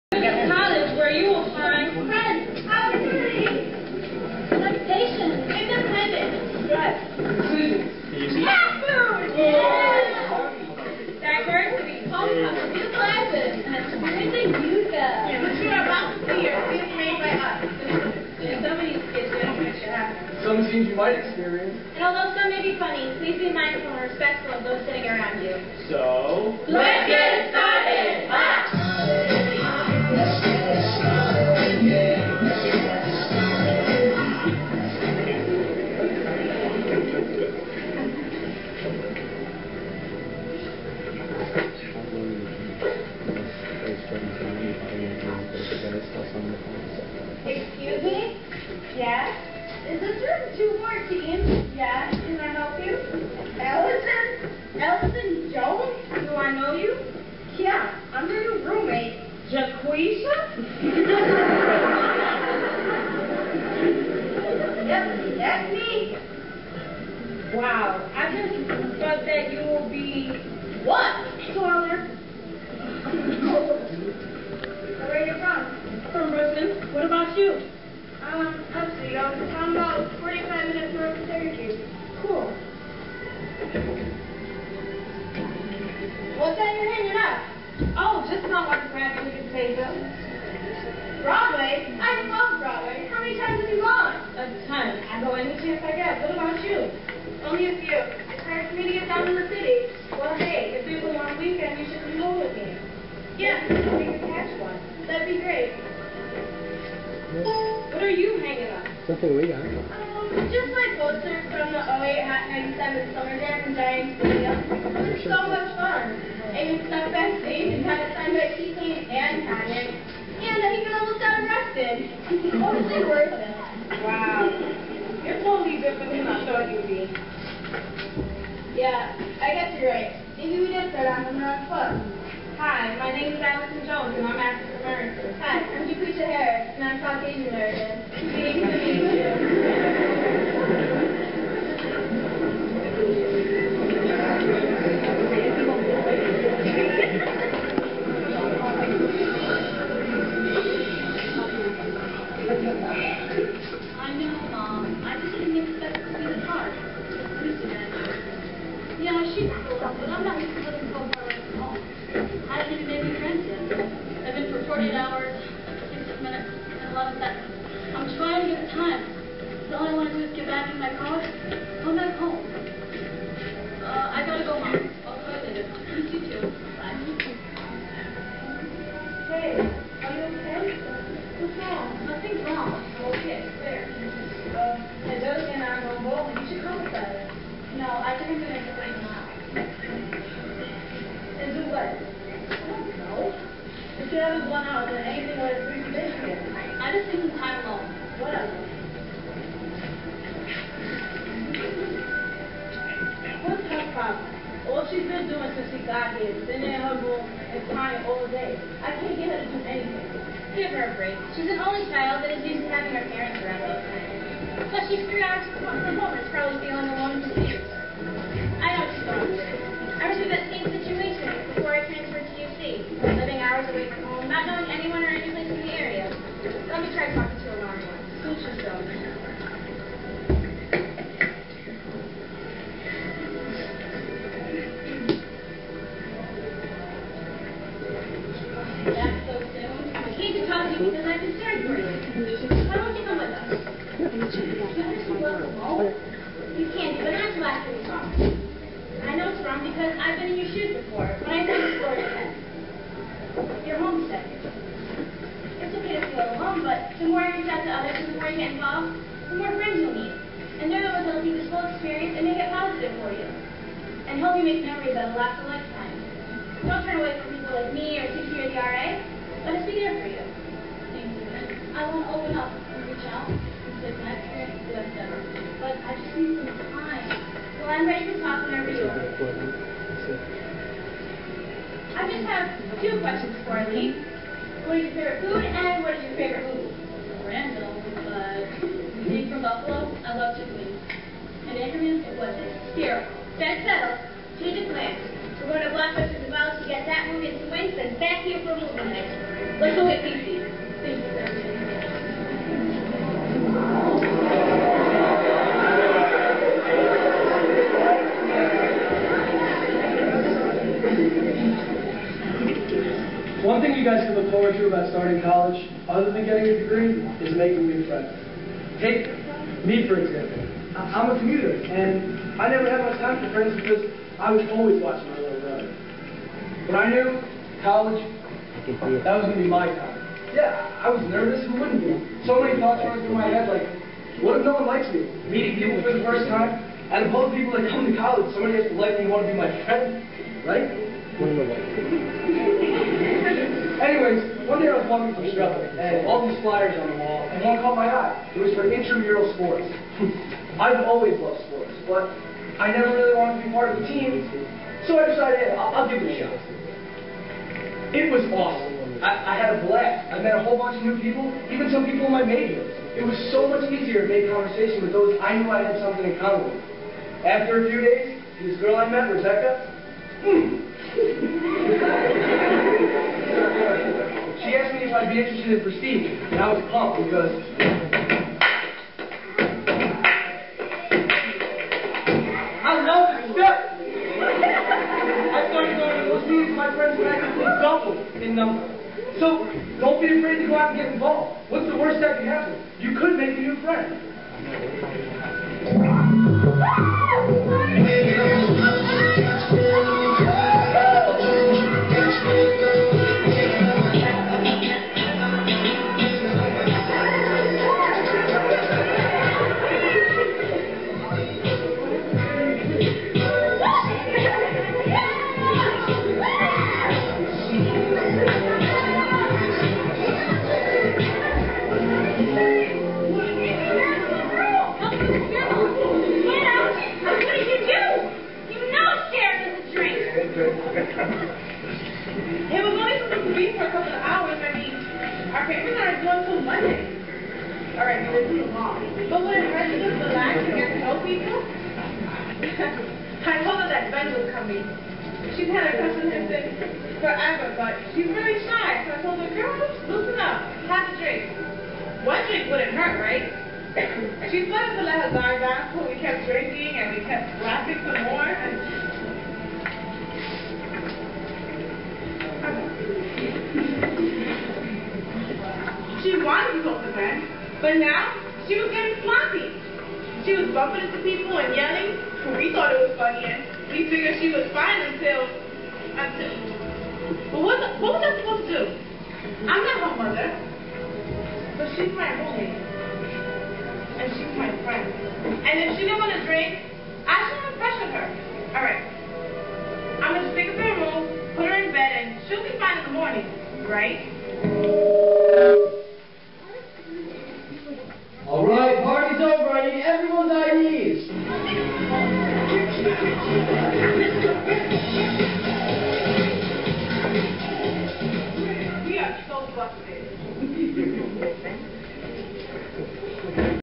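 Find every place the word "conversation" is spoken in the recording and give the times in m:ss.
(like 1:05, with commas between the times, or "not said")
6:04.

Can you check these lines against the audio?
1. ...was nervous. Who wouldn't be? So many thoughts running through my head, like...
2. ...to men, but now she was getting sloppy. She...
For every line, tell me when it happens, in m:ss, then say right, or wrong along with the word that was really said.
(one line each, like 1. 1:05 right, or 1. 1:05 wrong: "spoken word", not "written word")
1. 5:30 right
2. 7:46 right.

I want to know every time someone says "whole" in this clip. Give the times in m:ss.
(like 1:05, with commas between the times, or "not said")
4:21, 6:00.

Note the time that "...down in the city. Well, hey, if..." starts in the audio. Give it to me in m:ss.
1:39.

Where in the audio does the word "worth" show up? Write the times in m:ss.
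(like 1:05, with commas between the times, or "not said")
2:03.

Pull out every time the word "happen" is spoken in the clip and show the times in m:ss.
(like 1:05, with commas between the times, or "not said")
6:32.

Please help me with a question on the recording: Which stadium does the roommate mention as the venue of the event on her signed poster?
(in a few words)
Giant Stadium.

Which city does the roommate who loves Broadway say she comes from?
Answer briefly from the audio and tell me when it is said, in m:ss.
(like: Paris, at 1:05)
Brooklyn, at 1:16.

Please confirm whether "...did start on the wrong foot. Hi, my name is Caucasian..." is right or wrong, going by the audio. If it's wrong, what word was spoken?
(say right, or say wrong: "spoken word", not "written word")
wrong: "Allison", not "Caucasian".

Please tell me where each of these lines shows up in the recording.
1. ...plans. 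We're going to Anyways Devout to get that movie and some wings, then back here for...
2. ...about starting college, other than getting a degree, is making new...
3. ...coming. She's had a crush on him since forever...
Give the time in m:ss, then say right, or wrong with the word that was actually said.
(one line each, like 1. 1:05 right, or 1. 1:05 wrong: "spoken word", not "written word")
1. 4:54 wrong: "Blockbuster", not "Anyways"
2. 5:14 right
3. 7:24 right.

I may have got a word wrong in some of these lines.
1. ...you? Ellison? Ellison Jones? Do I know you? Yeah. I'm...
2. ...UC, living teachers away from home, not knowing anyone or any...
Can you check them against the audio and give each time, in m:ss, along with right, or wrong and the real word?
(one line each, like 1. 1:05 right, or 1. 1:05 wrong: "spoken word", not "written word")
1. 0:52 right
2. 3:42 wrong: "hours", not "teachers".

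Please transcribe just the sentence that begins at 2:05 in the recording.
You're totally different than I thought you'd be.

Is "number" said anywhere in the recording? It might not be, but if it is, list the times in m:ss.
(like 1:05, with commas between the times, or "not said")
6:28.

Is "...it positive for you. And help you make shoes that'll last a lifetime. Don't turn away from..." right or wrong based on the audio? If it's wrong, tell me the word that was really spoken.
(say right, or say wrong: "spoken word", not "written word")
wrong: "memories", not "shoes".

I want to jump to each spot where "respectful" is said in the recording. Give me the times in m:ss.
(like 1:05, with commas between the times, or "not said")
0:24.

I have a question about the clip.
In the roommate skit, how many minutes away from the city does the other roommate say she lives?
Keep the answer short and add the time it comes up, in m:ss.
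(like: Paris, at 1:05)
45, at 1:20.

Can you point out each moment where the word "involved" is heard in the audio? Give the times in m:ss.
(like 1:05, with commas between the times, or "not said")
4:18, 6:30.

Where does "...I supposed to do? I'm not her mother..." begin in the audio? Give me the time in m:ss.
7:58.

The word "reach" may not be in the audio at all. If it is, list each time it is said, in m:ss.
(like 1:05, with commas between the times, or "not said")
4:17, 4:32.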